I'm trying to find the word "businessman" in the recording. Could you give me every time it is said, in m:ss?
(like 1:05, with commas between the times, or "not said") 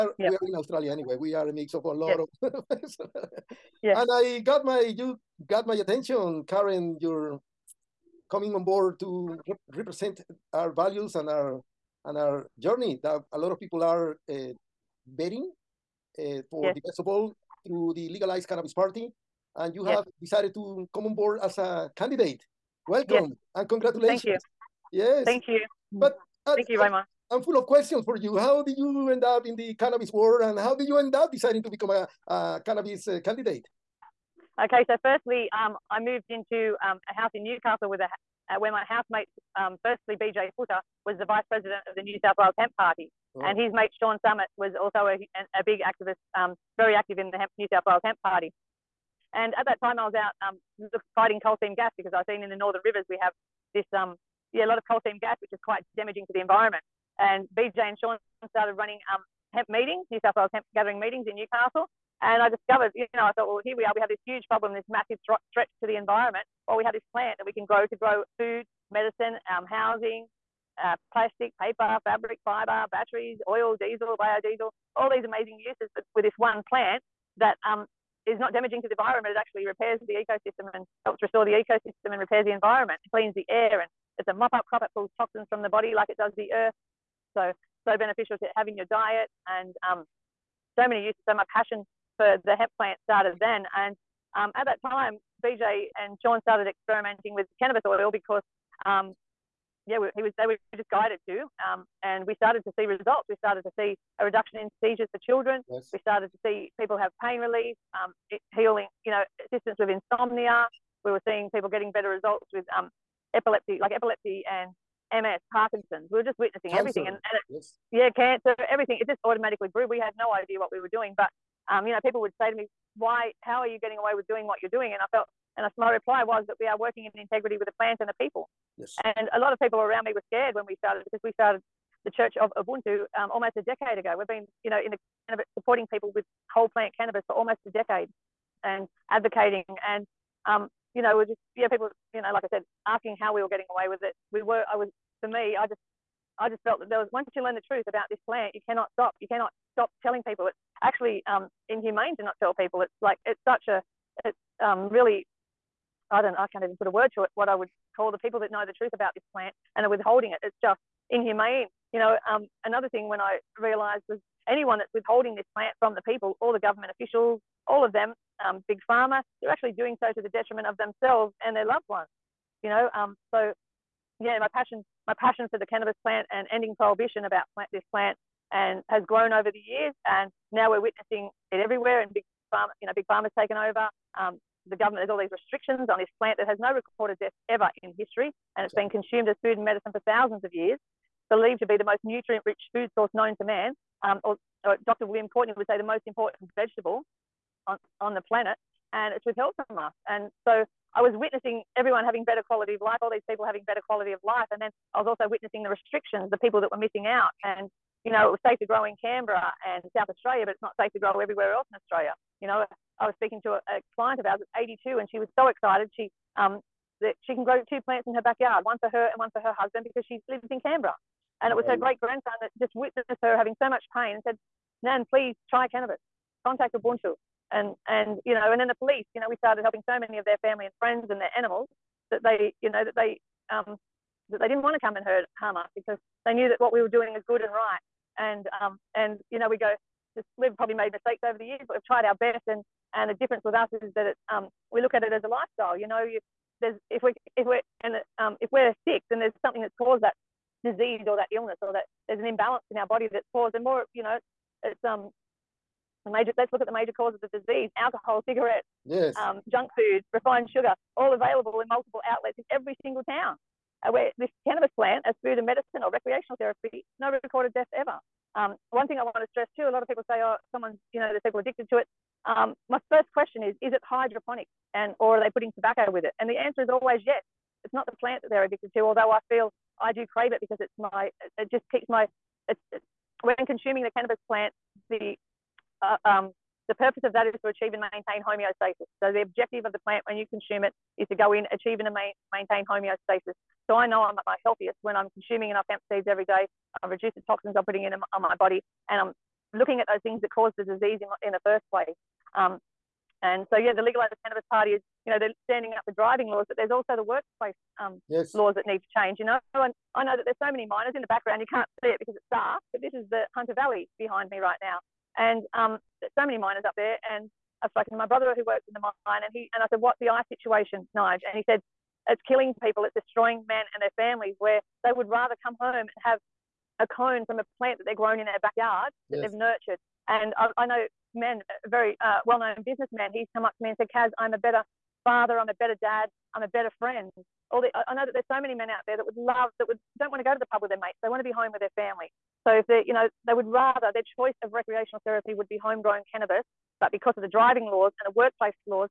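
5:32.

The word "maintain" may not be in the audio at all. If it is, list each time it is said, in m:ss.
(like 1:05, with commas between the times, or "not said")
4:47, 4:52.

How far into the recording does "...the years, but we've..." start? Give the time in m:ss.
4:01.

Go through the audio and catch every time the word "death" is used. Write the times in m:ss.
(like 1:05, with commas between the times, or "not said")
3:07, 4:27.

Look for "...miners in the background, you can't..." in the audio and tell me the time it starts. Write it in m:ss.
5:10.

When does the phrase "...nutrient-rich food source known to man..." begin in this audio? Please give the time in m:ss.
3:12.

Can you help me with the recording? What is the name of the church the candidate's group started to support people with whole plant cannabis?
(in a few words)
Church of Ubuntu.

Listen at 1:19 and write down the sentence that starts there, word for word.
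It actually repairs the ecosystem and helps restore the ecosystem and repairs the environment.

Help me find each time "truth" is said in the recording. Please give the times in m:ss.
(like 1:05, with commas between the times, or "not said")
2:27, 2:38.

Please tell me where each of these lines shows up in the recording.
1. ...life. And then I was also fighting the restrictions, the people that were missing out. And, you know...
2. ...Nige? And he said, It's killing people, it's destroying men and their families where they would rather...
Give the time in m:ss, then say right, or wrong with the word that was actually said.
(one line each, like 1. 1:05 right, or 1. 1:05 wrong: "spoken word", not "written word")
1. 3:24 wrong: "witnessing", not "fighting"
2. 5:20 right.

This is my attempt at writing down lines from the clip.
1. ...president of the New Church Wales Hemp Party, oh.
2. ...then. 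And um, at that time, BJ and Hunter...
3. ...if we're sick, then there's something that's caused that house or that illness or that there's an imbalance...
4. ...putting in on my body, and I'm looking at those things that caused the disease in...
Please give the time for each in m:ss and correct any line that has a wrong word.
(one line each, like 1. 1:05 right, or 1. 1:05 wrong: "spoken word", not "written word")
1. 0:41 wrong: "South", not "Church"
2. 1:33 wrong: "Sean", not "Hunter"
3. 4:08 wrong: "disease", not "house"
4. 4:57 right.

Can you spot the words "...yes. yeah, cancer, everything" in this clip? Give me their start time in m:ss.
1:57.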